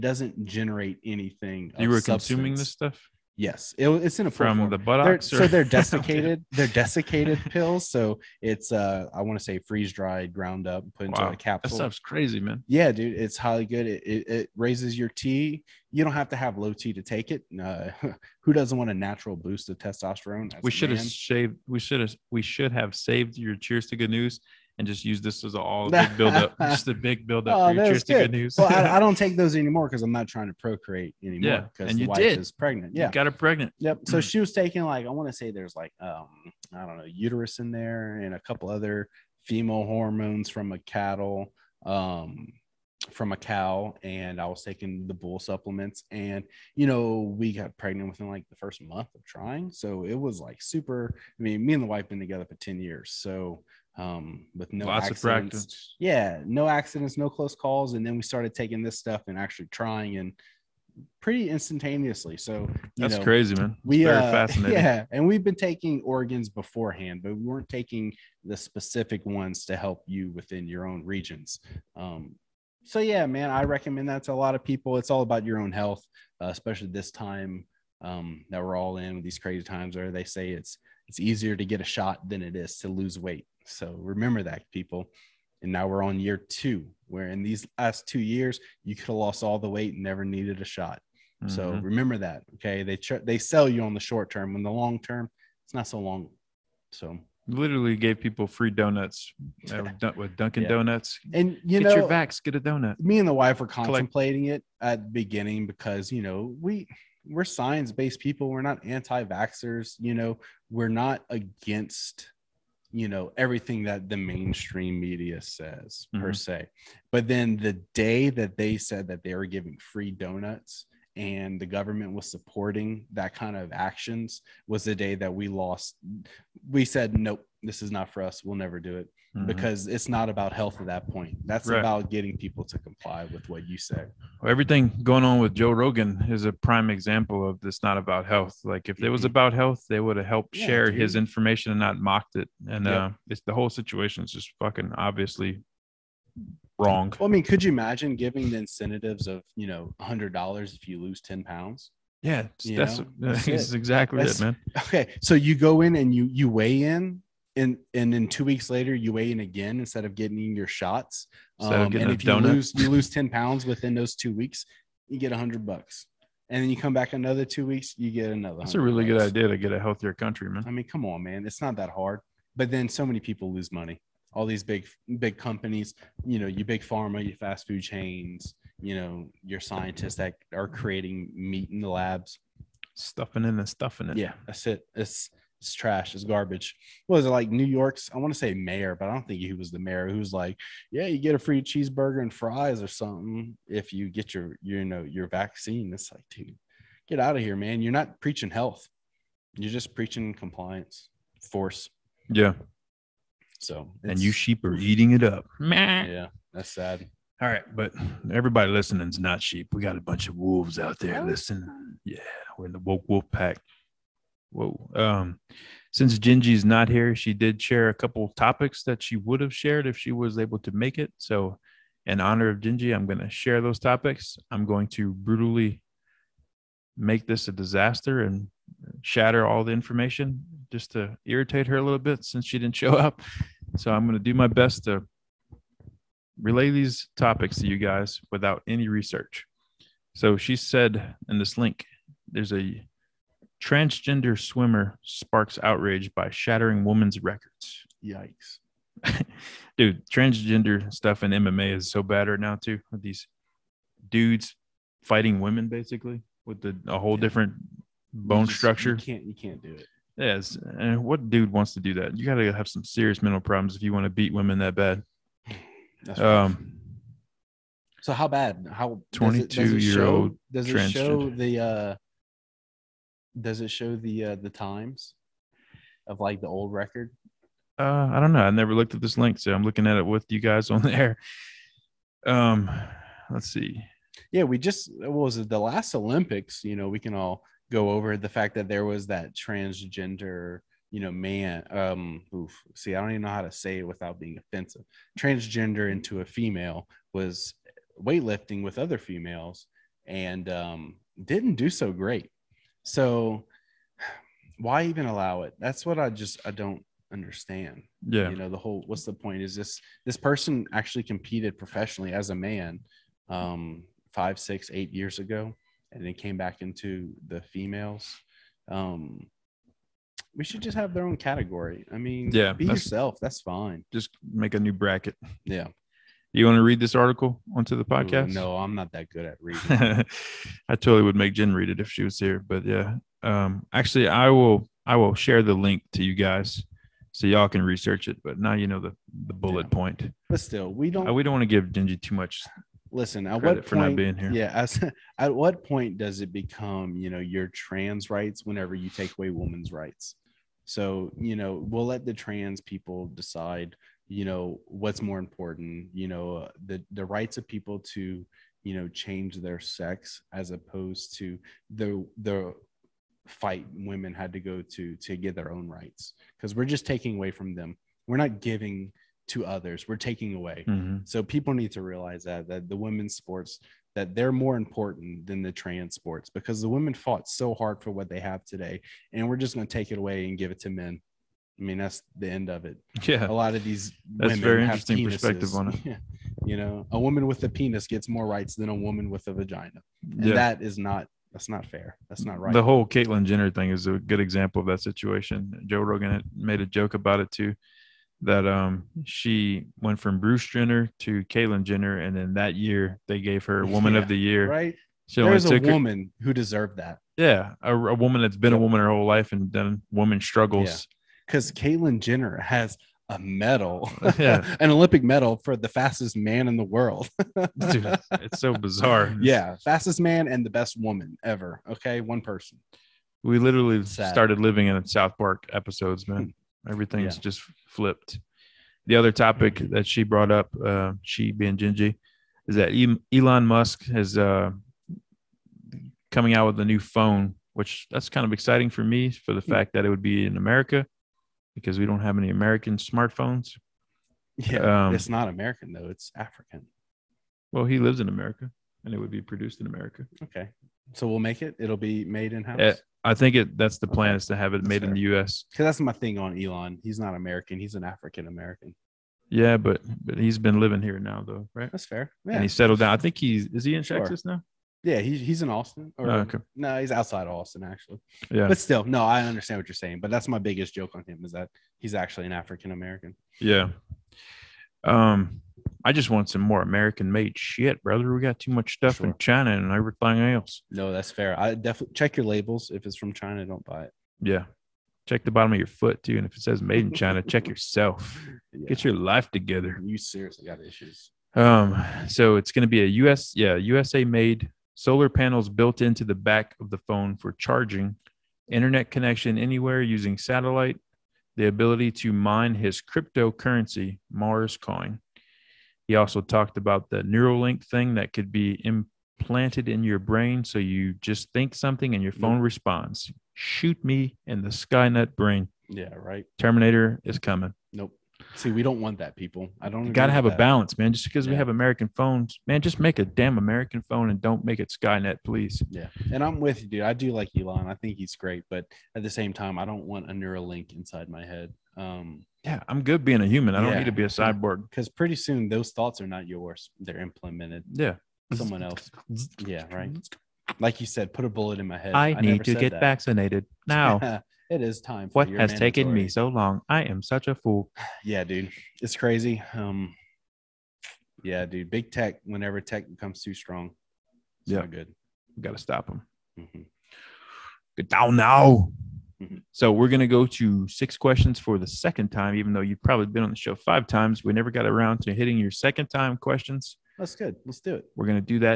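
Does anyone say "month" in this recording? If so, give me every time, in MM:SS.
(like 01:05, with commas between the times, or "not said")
00:48.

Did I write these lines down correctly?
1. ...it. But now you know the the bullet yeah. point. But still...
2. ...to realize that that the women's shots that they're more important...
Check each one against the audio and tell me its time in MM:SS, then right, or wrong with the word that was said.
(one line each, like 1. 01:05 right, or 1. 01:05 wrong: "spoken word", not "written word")
1. 05:38 right
2. 06:11 wrong: "sports", not "shots".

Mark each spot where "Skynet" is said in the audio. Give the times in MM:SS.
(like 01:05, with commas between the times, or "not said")
08:34, 08:44.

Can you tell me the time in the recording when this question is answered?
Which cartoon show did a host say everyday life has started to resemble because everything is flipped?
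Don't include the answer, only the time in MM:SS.
07:04.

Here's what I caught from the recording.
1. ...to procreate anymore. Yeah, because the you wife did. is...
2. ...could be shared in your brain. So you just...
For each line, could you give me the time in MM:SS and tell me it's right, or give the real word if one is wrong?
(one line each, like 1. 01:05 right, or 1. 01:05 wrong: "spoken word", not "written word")
1. 00:30 right
2. 08:28 wrong: "implanted", not "shared".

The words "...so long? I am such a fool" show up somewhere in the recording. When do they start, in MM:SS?
09:06.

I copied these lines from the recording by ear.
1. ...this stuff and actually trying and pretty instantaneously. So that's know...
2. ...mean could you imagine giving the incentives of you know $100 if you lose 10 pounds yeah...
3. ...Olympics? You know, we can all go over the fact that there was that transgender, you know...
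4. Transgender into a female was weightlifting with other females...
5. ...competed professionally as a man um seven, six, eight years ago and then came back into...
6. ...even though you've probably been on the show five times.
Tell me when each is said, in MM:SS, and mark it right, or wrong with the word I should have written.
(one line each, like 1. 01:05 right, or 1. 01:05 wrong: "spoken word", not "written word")
1. 00:58 right
2. 02:27 right
3. 04:45 right
4. 04:55 right
5. 05:11 wrong: "five", not "seven"
6. 09:22 right.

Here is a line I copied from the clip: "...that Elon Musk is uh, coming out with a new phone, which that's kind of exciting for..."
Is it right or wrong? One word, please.
right.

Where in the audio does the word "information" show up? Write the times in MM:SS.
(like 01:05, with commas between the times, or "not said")
02:21, 03:49.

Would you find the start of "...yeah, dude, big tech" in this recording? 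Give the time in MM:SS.
09:11.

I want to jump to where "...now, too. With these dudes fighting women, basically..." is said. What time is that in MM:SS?
04:12.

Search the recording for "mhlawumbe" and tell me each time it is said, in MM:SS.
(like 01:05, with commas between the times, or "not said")
not said.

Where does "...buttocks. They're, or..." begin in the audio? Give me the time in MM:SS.
00:04.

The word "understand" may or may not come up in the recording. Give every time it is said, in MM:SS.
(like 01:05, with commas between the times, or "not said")
05:07, 07:49.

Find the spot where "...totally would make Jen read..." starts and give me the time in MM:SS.
05:30.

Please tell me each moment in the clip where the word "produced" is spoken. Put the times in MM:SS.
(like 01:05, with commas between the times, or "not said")
07:29.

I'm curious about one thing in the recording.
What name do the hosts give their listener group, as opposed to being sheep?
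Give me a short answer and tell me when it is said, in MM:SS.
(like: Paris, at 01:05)
woke wolf pack, at 03:32.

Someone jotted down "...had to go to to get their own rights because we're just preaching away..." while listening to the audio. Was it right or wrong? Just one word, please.
wrong.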